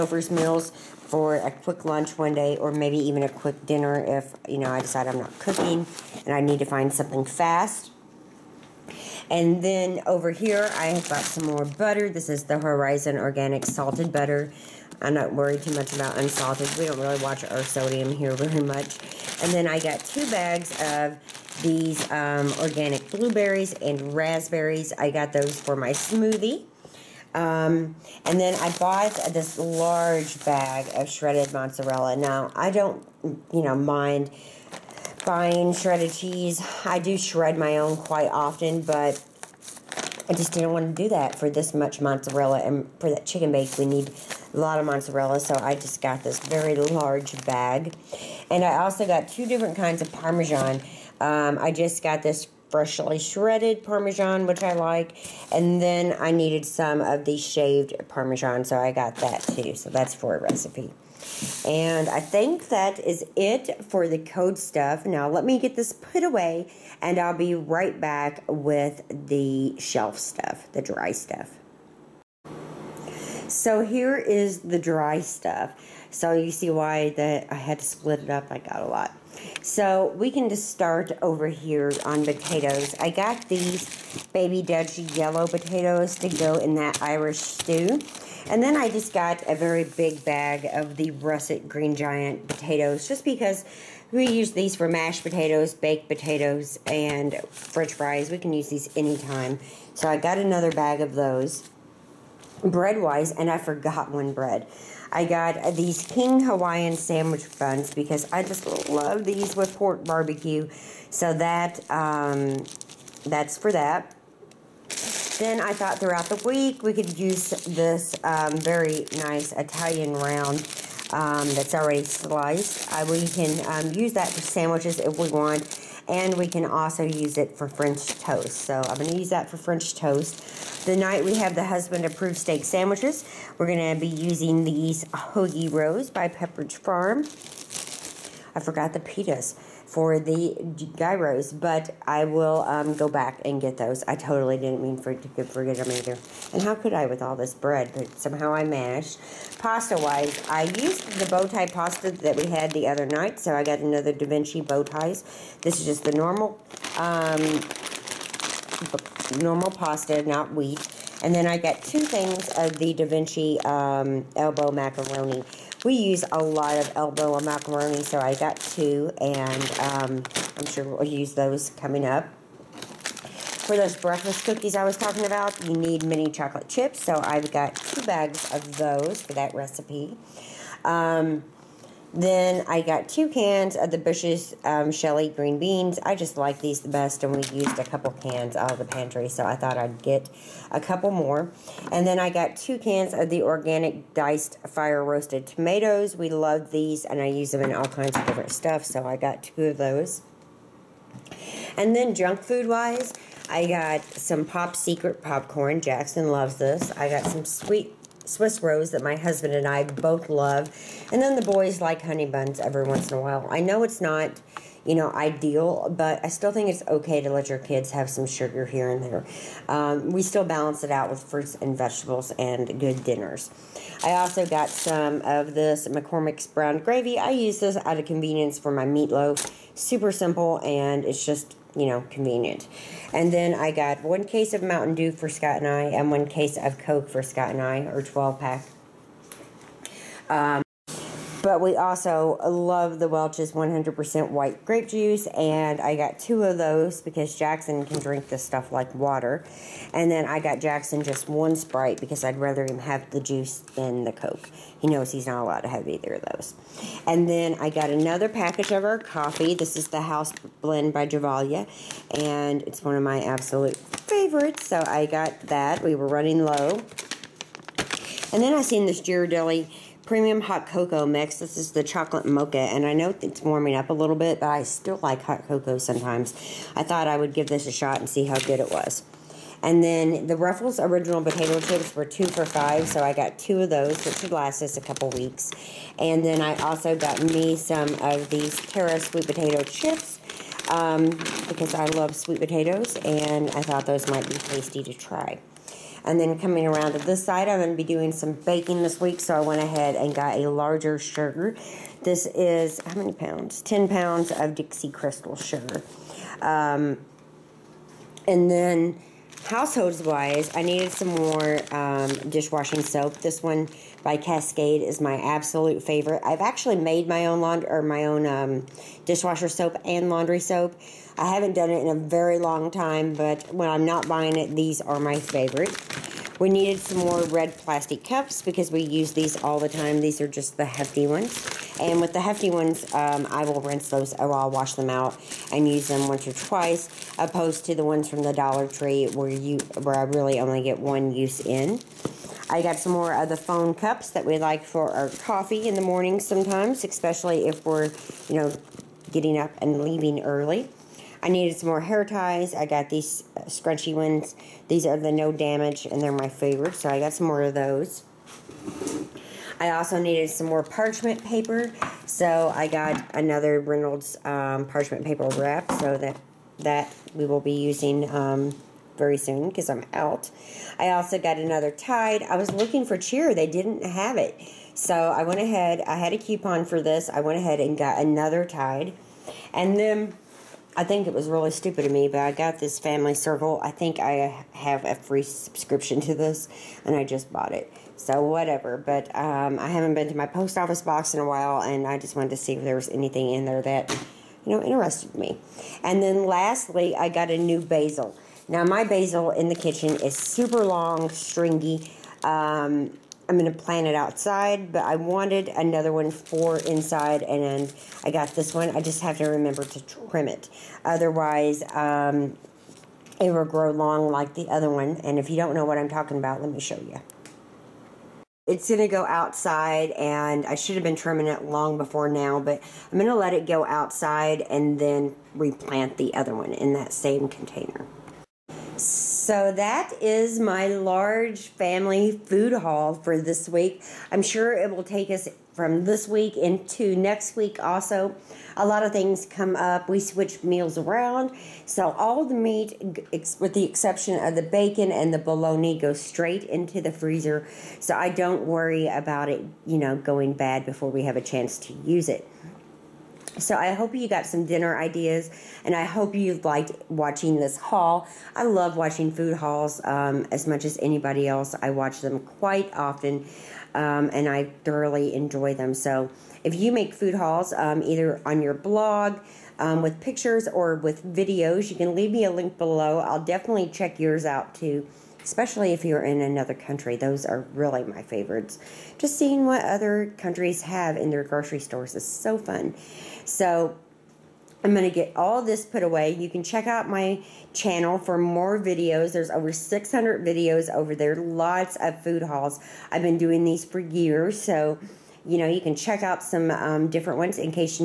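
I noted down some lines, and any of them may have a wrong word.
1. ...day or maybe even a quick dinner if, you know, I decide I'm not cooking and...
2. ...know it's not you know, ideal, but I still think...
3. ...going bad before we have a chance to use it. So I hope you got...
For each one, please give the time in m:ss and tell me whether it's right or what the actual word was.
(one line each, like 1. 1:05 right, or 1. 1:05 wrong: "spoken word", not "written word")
1. 0:02 right
2. 3:33 right
3. 7:29 right.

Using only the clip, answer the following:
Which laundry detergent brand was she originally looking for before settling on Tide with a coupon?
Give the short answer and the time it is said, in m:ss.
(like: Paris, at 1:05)
Cheer, at 6:12.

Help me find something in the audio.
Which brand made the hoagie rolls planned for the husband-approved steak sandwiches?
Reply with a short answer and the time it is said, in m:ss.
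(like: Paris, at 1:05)
Pepperidge Farm, at 2:16.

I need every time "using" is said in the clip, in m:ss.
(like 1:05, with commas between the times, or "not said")
2:14, 6:07.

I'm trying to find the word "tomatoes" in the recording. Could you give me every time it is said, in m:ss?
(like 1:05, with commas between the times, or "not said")
3:15.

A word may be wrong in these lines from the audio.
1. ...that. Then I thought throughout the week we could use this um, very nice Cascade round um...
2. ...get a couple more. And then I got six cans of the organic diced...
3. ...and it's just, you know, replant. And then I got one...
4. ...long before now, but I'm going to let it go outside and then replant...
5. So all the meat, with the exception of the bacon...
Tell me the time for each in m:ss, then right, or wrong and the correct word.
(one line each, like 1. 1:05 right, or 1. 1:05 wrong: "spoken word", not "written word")
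1. 1:53 wrong: "Italian", not "Cascade"
2. 3:10 wrong: "two", not "six"
3. 3:50 wrong: "convenient", not "replant"
4. 7:01 right
5. 7:21 right.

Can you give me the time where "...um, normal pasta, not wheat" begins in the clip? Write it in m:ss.
2:36.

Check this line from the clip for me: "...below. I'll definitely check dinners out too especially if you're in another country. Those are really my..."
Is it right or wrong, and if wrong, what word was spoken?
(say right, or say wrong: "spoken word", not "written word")
wrong: "yours", not "dinners".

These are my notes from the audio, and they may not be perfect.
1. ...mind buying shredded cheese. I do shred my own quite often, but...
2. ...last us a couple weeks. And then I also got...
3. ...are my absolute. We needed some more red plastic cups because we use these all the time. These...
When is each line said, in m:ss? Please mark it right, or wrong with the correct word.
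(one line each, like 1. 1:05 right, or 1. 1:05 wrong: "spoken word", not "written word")
1. 0:33 right
2. 4:44 right
3. 5:24 wrong: "favorite", not "absolute".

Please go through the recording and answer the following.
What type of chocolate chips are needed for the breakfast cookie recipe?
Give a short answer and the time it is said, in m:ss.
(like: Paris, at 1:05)
mini chocolate chips, at 2:56.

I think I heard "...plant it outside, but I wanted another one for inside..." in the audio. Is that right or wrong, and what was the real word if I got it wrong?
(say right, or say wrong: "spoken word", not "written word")
right.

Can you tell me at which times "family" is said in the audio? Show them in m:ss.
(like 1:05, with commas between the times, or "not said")
6:22, 7:11.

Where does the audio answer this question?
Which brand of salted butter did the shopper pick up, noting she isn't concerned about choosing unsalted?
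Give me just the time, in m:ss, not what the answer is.
0:12.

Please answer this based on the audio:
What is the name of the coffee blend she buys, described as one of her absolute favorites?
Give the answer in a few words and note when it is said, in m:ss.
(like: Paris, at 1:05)
House Blend, at 4:20.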